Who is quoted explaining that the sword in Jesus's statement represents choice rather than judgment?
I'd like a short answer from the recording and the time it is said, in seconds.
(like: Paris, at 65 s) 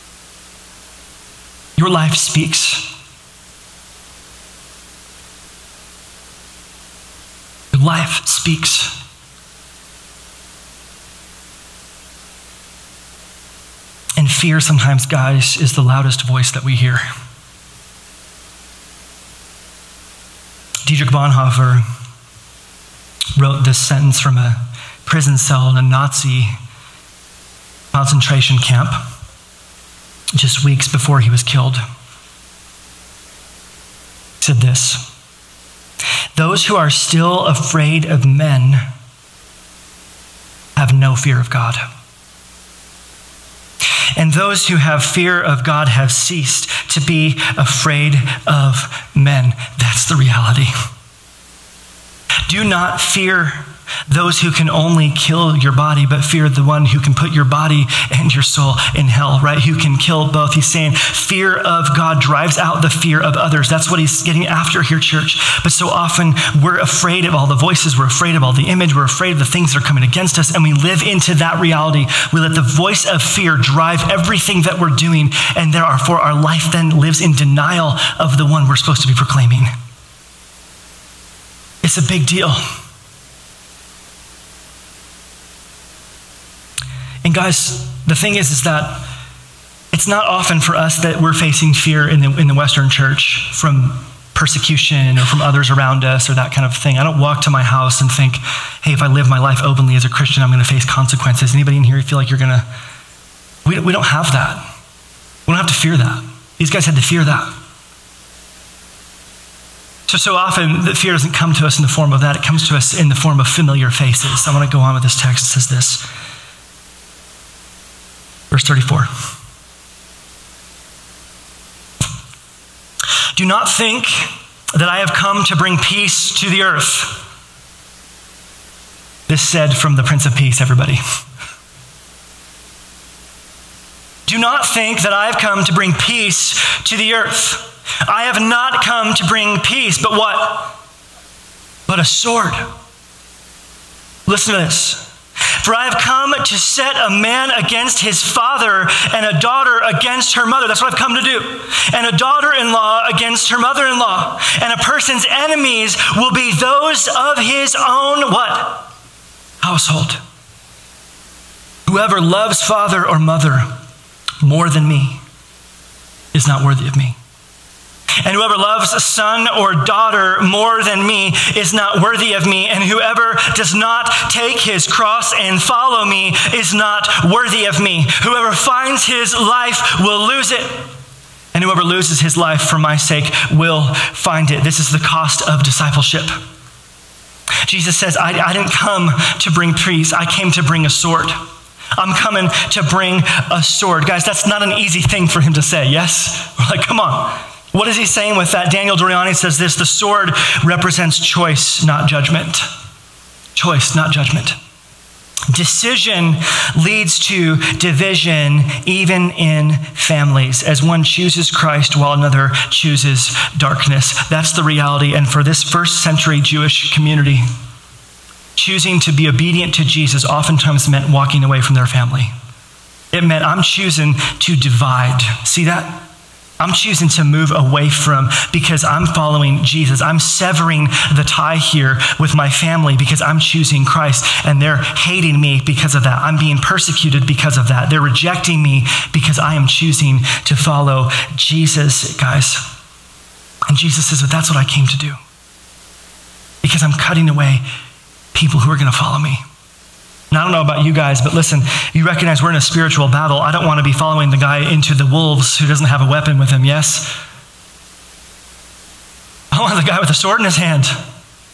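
Daniel Doriani, at 198 s.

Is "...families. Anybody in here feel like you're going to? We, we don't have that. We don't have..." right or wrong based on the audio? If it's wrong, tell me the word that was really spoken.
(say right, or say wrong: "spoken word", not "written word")
wrong: "consequences", not "families".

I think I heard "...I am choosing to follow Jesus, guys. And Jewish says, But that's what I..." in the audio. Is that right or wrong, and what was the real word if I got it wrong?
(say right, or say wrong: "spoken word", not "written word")
wrong: "Jesus", not "Jewish".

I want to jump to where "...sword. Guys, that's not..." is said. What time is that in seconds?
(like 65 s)
193 s.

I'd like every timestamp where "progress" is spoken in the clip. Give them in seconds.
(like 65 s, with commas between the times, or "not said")
not said.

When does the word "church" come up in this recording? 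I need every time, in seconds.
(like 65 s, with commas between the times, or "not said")
64 s, 92 s.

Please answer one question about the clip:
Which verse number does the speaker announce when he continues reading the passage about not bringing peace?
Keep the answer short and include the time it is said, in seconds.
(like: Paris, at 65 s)
34, at 118 s.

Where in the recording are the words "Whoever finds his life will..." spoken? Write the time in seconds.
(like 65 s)
178 s.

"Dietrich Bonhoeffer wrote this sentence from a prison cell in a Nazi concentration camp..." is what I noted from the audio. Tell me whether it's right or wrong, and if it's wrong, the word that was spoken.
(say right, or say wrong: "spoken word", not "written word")
right.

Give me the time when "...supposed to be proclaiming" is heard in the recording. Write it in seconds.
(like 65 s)
78 s.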